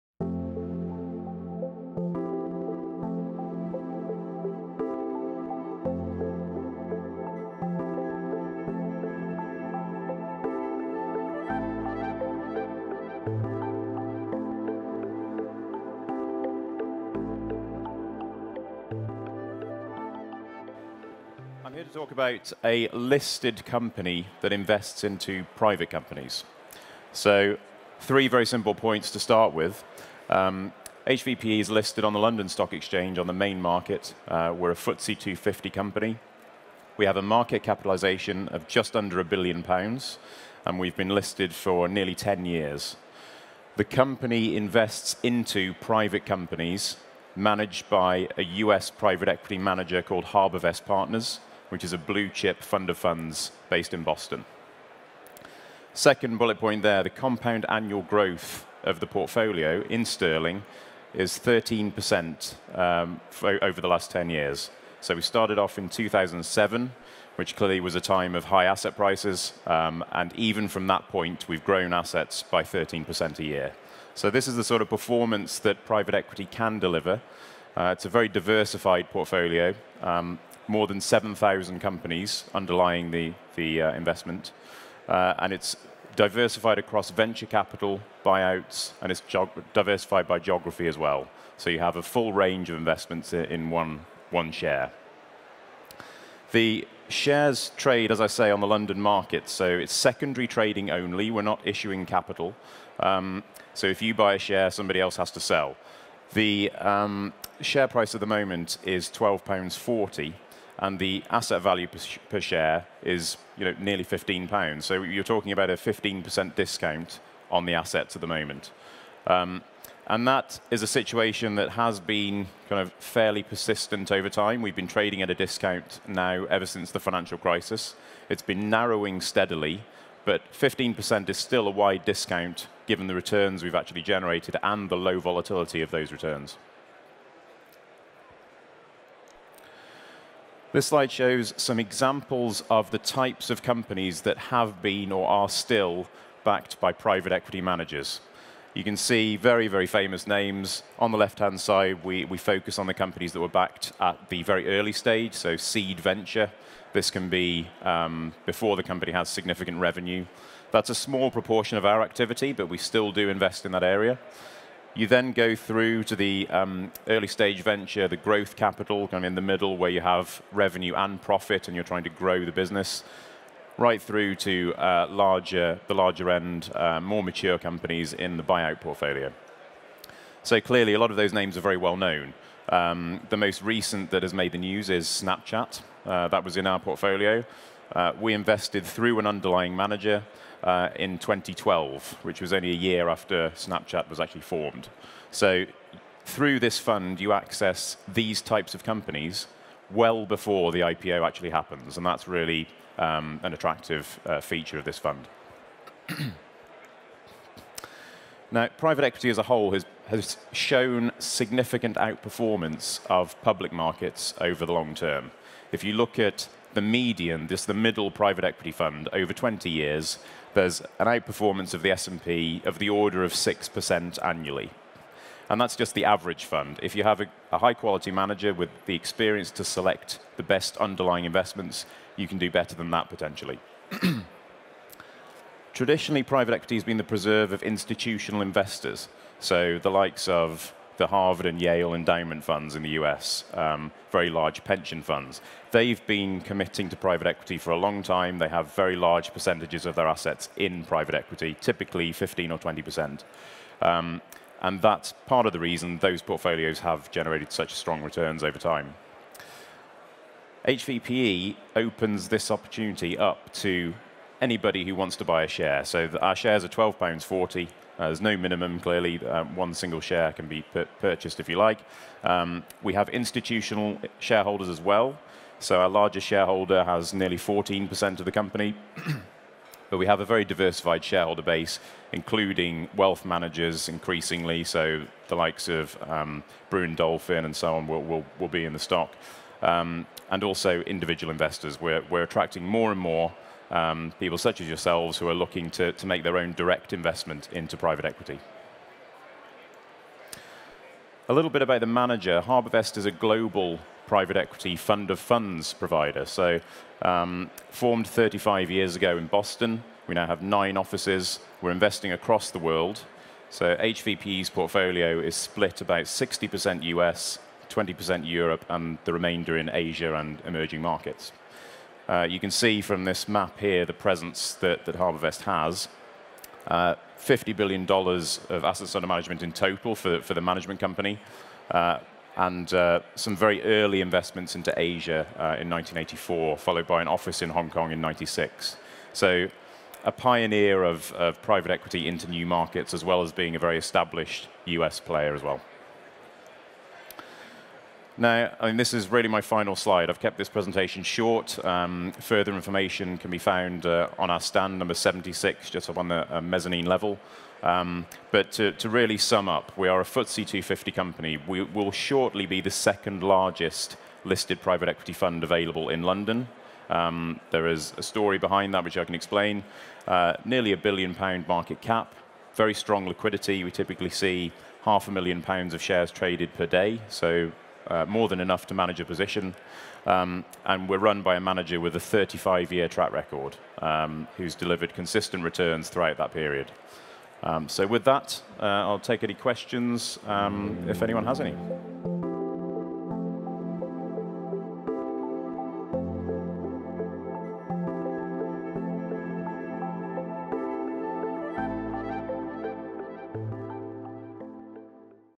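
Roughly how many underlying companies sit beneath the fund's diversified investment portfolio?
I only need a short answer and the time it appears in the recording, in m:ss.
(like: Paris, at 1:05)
More than 7,000, at 1:20.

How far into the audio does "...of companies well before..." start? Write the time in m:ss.
3:18.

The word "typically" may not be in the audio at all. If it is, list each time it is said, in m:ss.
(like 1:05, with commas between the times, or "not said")
4:11, 6:13.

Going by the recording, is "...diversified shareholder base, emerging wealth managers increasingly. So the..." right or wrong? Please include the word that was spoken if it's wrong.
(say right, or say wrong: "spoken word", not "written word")
wrong: "including", not "emerging".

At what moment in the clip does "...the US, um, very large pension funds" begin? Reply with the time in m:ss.
4:02.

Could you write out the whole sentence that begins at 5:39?
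So a pioneer of, of private equity into new markets, as well as being a very established US player as well.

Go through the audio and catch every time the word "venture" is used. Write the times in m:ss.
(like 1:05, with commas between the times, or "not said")
1:27, 2:35, 2:47.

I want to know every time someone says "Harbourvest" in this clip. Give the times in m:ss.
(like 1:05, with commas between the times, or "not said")
0:50, 5:02, 5:24.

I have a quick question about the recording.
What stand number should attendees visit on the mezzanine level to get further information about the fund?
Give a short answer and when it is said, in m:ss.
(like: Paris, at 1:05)
76, at 5:54.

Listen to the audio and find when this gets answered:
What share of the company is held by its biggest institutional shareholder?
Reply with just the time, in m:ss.
4:37.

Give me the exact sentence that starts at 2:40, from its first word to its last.
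That's a small proportion of our activity, but we still do invest in that area.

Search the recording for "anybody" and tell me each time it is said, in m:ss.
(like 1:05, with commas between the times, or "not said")
4:24.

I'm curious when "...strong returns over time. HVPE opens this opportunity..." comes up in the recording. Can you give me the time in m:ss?
4:17.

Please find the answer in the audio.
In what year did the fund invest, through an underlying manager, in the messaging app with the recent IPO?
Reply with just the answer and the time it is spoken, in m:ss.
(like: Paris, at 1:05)
2012, at 3:11.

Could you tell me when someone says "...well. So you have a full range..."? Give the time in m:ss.
1:30.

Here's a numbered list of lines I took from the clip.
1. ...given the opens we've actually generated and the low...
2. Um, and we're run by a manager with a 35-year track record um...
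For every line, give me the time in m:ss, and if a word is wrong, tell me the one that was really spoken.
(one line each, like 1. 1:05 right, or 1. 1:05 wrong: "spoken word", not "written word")
1. 2:12 wrong: "returns", not "opens"
2. 6:20 right.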